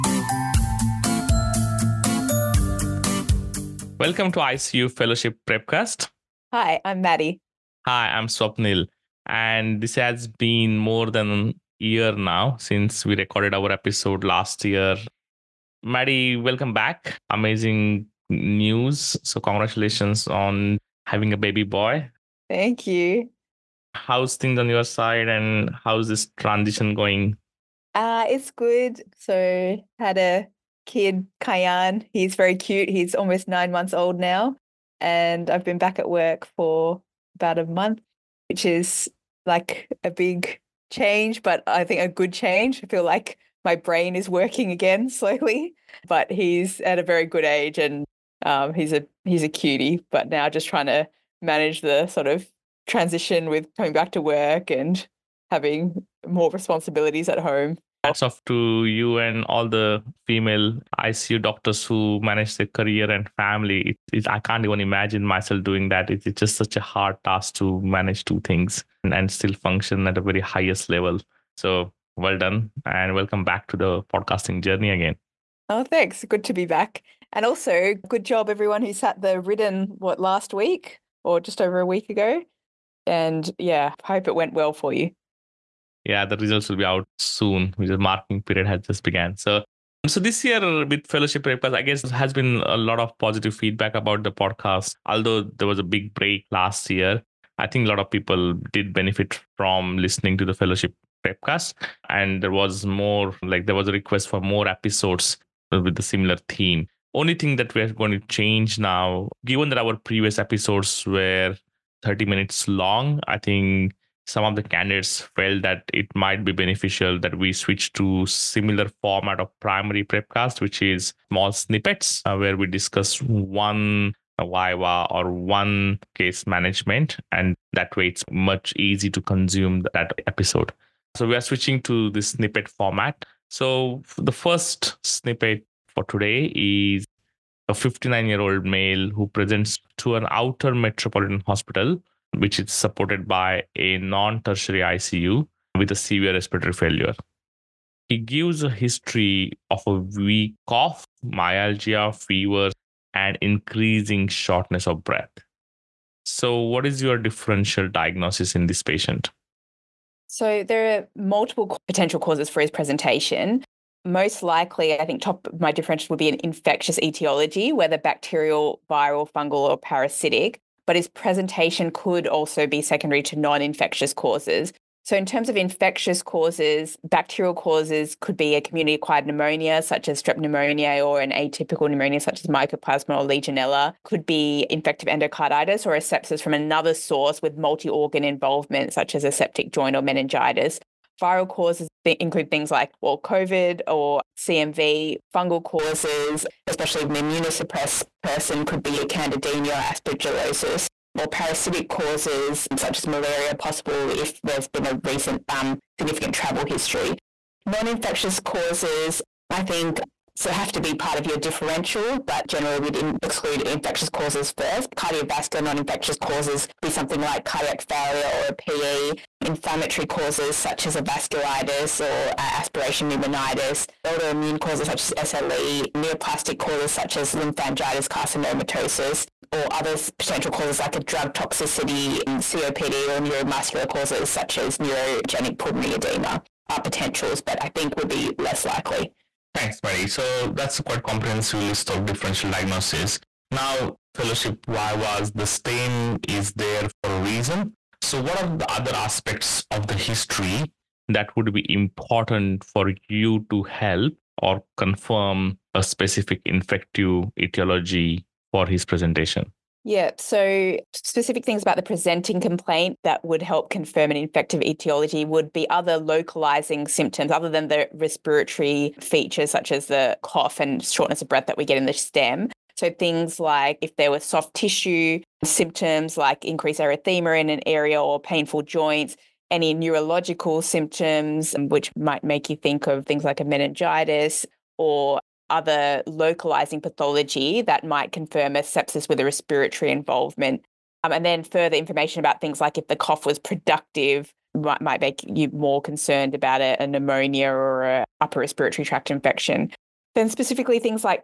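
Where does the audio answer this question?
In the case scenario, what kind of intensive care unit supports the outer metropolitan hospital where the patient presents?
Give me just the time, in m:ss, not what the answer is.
2:23.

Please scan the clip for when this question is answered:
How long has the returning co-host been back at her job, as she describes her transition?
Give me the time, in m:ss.
0:37.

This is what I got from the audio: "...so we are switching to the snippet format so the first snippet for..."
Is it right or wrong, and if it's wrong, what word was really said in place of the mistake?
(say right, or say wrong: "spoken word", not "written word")
right.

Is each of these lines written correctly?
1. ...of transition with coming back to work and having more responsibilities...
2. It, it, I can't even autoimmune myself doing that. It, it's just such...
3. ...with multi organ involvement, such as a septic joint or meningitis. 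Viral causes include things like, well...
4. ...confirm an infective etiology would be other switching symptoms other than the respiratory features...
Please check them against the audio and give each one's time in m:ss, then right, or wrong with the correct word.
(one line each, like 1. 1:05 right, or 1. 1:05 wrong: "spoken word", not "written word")
1. 0:52 right
2. 1:03 wrong: "imagine", not "autoimmune"
3. 3:07 right
4. 4:23 wrong: "localizing", not "switching".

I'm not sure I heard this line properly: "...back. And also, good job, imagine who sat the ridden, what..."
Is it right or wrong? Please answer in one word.
wrong.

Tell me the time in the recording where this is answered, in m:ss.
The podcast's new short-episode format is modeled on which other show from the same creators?
1:59.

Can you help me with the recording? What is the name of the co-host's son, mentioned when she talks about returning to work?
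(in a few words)
Kayan.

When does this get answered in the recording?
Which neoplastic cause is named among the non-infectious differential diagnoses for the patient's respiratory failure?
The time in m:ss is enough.
3:47.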